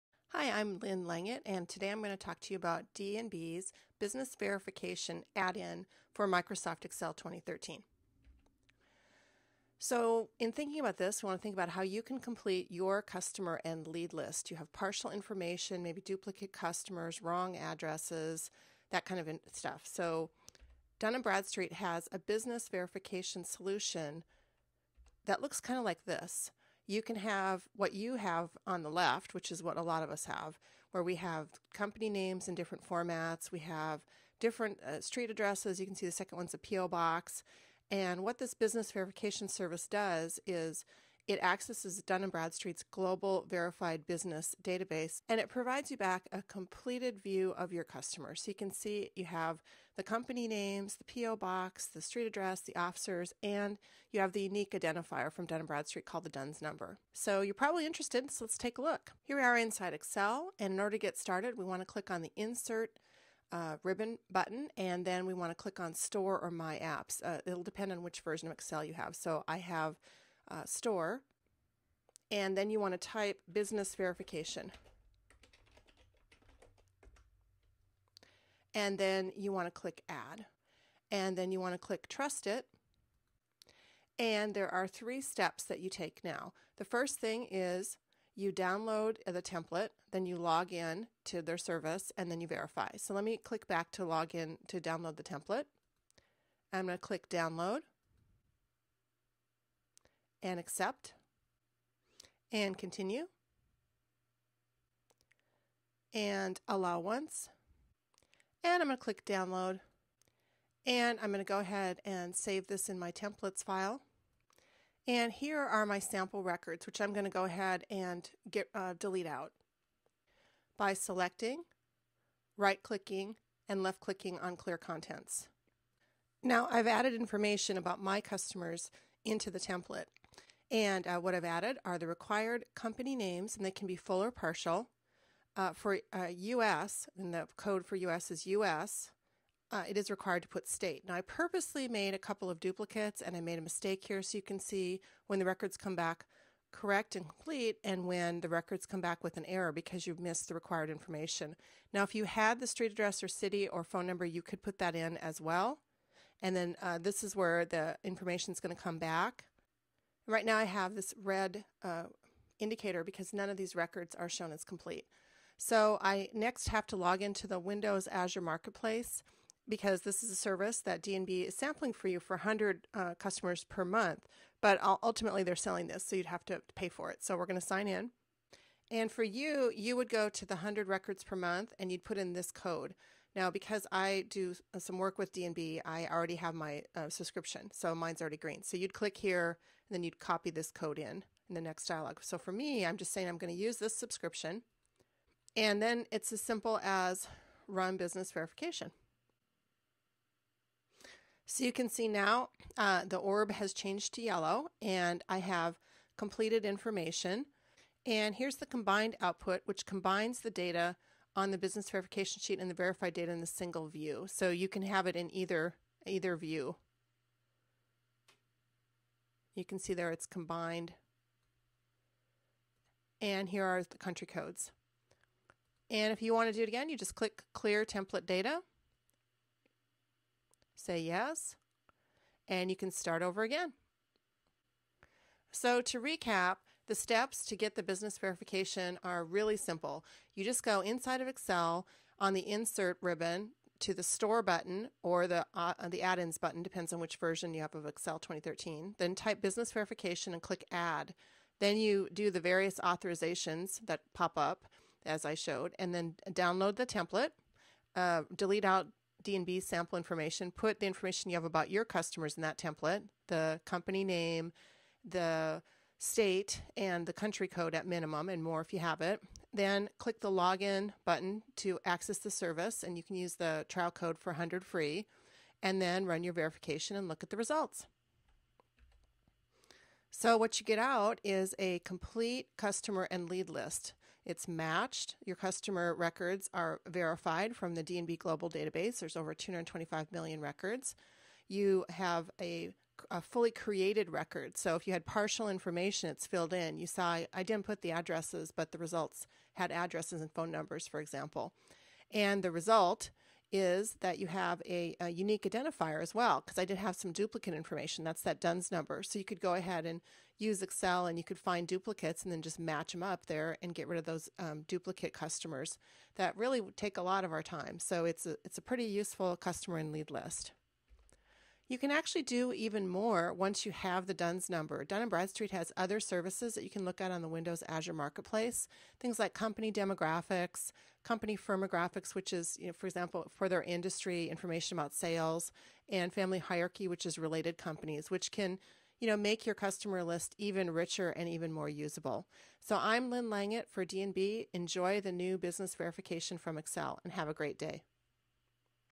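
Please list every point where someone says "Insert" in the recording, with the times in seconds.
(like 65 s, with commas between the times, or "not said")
62 s, 242 s.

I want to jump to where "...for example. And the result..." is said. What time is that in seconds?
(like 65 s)
300 s.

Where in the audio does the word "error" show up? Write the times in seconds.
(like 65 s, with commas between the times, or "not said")
149 s.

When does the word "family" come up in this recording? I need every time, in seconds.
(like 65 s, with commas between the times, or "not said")
336 s.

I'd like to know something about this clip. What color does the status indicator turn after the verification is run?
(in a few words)
Yellow.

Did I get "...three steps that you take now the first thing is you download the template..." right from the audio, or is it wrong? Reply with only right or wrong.
right.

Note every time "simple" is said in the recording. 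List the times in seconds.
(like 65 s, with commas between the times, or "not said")
196 s, 239 s.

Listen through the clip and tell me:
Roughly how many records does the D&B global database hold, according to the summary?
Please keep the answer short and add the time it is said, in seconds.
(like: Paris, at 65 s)
225 million, at 289 s.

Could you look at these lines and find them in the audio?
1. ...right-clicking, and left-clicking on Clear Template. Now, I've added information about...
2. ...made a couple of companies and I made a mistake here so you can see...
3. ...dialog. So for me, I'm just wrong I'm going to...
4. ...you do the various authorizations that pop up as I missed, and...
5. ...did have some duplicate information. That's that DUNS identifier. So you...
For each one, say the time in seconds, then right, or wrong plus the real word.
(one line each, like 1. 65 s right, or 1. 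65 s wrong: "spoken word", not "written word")
1. 122 s wrong: "Contents", not "Template"
2. 141 s wrong: "duplicates", not "companies"
3. 191 s wrong: "saying", not "wrong"
4. 251 s wrong: "showed", not "missed"
5. 306 s wrong: "number", not "identifier".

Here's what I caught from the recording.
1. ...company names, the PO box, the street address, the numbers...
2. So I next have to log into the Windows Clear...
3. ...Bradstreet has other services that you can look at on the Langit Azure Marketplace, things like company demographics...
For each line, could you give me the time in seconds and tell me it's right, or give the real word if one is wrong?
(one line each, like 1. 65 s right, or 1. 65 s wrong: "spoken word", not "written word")
1. 50 s wrong: "officers", not "numbers"
2. 165 s wrong: "Azure", not "Clear"
3. 325 s wrong: "Windows", not "Langit".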